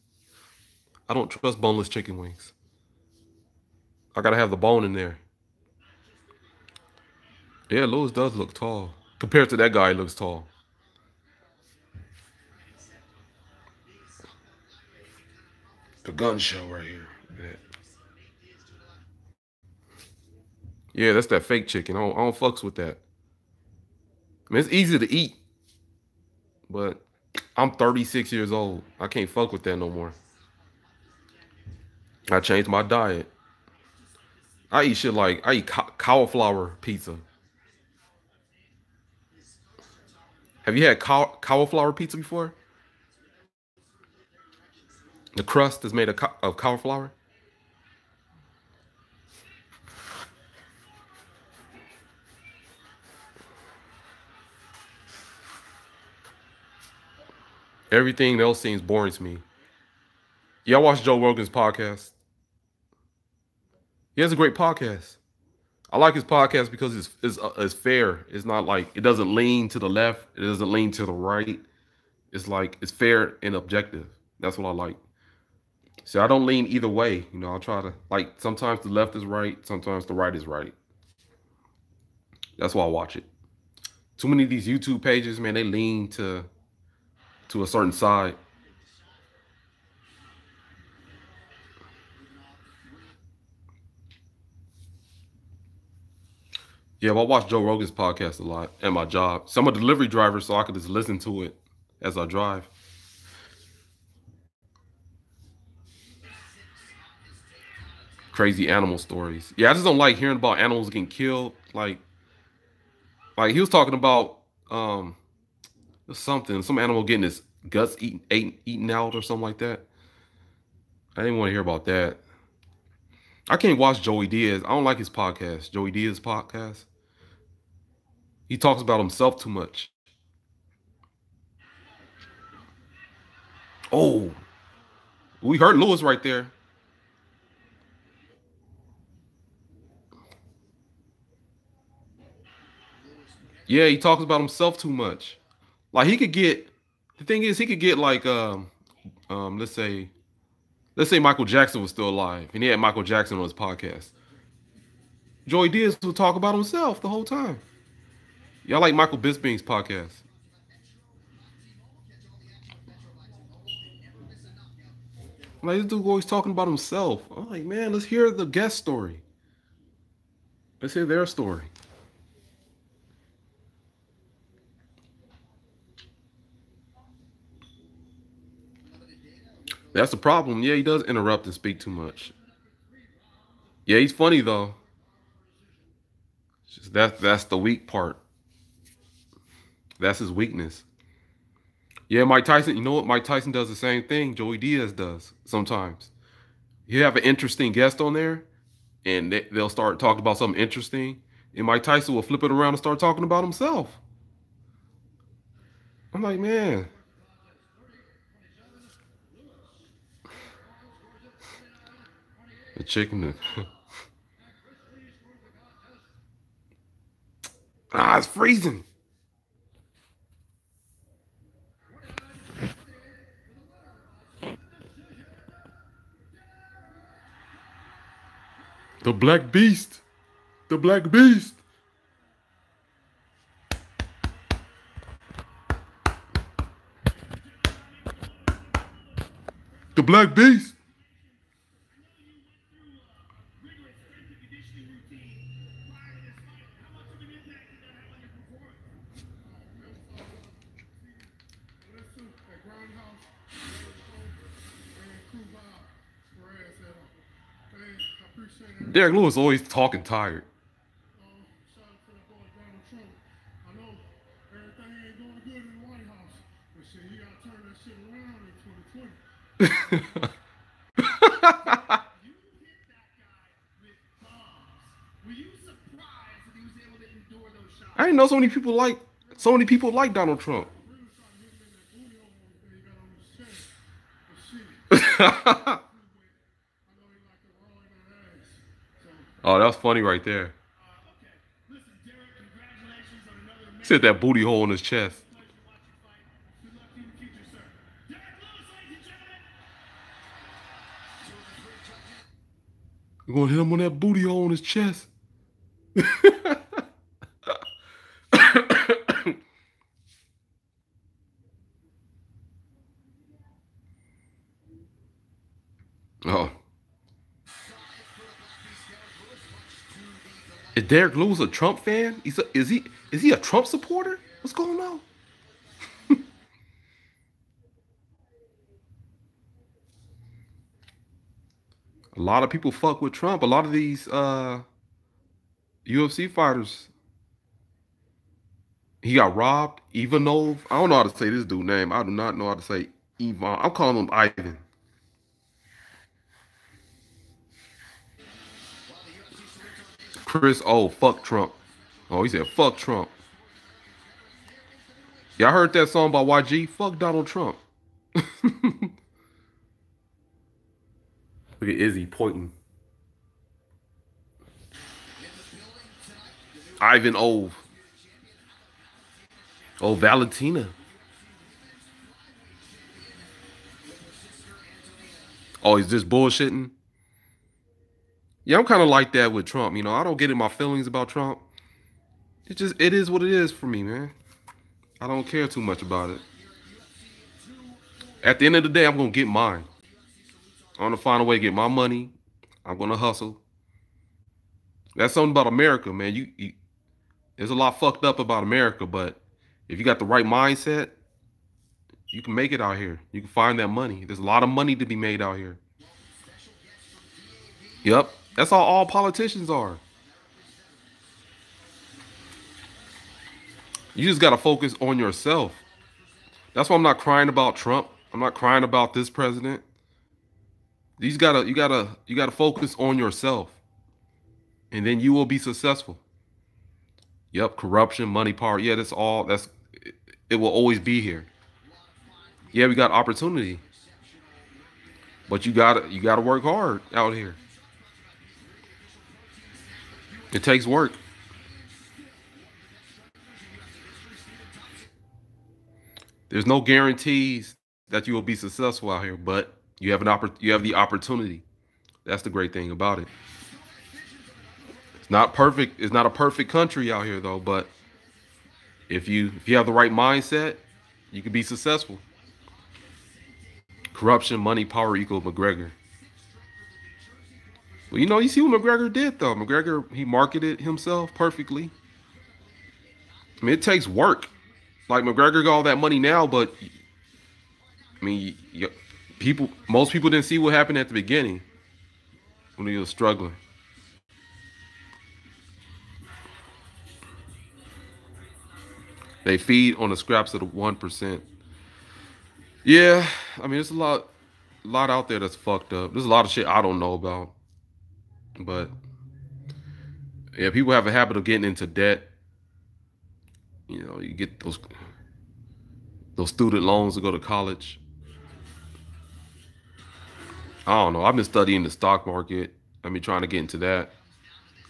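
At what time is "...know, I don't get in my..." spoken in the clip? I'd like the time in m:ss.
6:19.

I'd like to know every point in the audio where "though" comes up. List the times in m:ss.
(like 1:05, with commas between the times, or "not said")
3:04, 7:37, 7:49.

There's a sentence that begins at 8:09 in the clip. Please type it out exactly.
They feed on the scraps of the one percent.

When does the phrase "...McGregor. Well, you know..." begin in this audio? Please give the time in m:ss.
7:45.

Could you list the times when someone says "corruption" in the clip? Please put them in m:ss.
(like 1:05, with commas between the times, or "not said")
7:07, 7:43.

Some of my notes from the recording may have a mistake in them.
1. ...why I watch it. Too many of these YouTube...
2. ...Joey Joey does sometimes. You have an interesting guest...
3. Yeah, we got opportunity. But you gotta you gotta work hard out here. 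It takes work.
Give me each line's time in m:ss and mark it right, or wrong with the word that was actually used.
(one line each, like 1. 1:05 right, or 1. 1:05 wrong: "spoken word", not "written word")
1. 1:22 right
2. 3:14 wrong: "Diaz", not "Joey"
3. 7:12 right.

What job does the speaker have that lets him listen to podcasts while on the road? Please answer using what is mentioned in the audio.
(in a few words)
Delivery driver.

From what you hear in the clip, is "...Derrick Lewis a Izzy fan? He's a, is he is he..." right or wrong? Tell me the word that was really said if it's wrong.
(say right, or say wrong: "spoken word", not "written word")
wrong: "Trump", not "Izzy".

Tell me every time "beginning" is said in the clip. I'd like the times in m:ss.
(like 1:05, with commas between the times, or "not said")
8:00.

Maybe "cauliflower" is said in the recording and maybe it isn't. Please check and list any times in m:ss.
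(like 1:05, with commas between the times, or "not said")
0:35, 0:41, 0:46.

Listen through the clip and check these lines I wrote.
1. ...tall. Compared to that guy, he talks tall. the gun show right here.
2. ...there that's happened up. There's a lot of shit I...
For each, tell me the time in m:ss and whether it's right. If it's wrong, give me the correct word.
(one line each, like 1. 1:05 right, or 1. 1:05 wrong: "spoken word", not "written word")
1. 0:08 wrong: "looks", not "talks"
2. 8:15 wrong: "fucked", not "happened".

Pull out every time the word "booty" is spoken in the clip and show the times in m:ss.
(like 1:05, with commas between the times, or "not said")
4:54, 5:03.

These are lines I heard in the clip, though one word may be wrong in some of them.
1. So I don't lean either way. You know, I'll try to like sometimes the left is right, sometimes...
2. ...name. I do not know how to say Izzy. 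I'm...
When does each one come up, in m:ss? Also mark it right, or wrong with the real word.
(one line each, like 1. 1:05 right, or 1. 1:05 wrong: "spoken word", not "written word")
1. 1:16 right
2. 5:41 wrong: "Ivan", not "Izzy".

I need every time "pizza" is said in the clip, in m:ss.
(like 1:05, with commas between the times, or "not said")
0:36, 0:41.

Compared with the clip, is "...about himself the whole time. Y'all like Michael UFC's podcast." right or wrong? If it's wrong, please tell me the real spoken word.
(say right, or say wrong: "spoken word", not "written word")
wrong: "Bisping", not "UFC".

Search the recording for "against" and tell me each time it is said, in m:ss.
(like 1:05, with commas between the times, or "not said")
not said.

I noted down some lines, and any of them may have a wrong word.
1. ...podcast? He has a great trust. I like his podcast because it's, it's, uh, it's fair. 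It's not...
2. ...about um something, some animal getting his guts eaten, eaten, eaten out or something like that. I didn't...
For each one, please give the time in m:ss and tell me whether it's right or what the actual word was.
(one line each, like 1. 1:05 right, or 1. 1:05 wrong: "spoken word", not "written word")
1. 1:01 wrong: "podcast", not "trust"
2. 1:53 right.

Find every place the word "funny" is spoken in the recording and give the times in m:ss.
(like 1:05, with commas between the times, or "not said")
3:04, 4:49.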